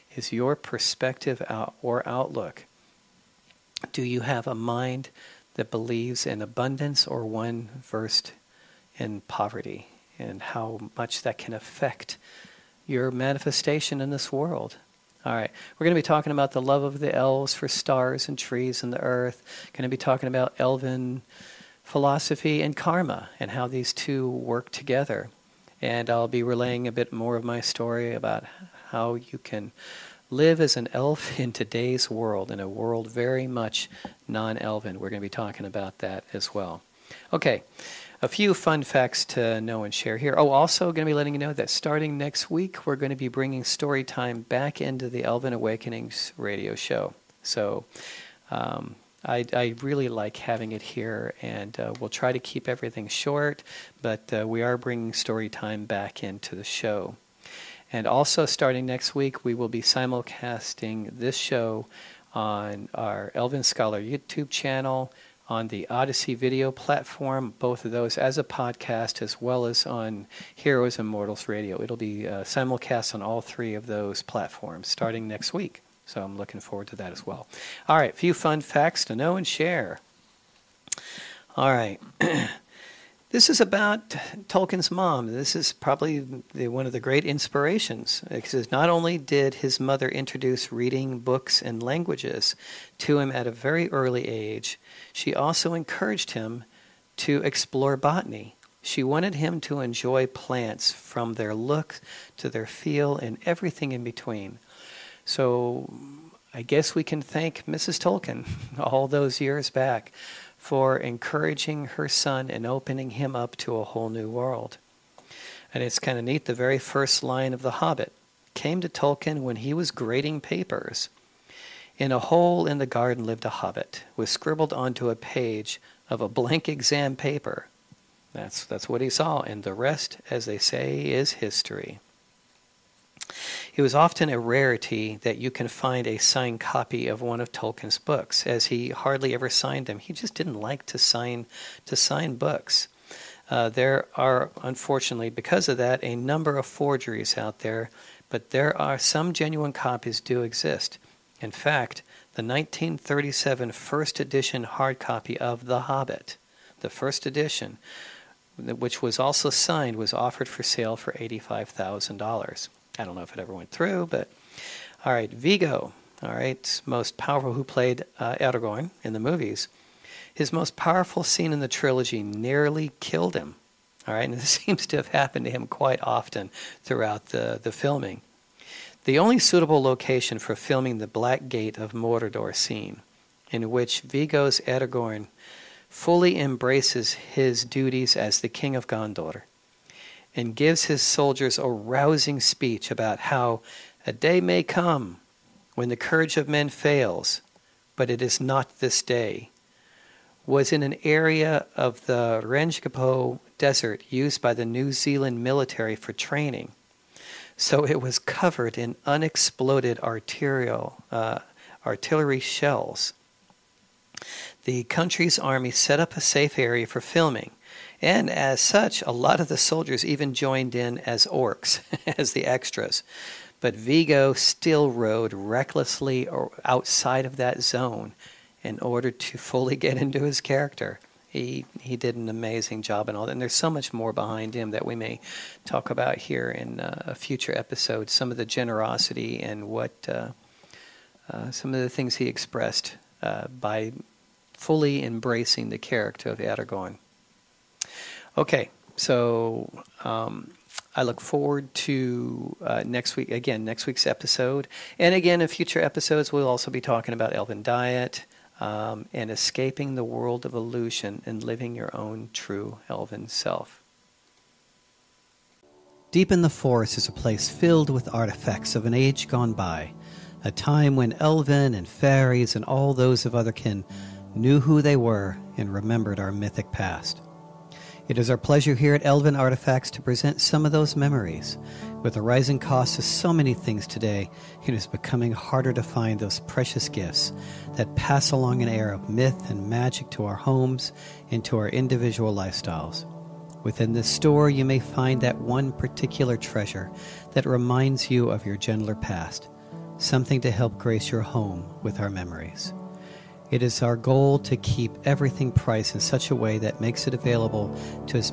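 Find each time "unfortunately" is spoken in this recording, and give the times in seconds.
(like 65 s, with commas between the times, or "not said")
144 s.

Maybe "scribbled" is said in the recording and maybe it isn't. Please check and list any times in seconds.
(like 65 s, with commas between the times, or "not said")
124 s.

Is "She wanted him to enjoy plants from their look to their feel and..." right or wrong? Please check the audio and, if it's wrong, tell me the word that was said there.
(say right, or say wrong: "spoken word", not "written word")
right.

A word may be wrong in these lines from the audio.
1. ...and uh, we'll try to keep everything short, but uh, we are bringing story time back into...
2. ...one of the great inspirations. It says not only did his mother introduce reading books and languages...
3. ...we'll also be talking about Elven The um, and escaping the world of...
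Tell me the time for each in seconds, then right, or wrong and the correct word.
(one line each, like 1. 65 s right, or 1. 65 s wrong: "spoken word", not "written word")
1. 51 s right
2. 86 s right
3. 256 s wrong: "Diet", not "The".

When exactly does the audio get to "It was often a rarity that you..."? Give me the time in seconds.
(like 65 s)
133 s.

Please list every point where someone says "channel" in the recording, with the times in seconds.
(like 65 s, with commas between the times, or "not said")
64 s.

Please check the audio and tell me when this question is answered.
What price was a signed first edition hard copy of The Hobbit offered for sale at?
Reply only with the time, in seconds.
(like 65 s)
161 s.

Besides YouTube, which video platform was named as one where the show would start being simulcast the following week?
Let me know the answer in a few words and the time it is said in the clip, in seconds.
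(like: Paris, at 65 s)
Odysee, at 65 s.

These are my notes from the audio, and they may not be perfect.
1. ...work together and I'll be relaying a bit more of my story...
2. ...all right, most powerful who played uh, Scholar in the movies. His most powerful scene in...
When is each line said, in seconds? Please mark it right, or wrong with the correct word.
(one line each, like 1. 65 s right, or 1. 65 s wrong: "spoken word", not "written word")
1. 24 s right
2. 166 s wrong: "Aragorn", not "Scholar".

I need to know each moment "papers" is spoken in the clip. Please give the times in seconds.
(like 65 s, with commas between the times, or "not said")
120 s, 127 s.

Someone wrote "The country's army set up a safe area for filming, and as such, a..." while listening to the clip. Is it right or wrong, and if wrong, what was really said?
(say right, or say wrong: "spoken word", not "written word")
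right.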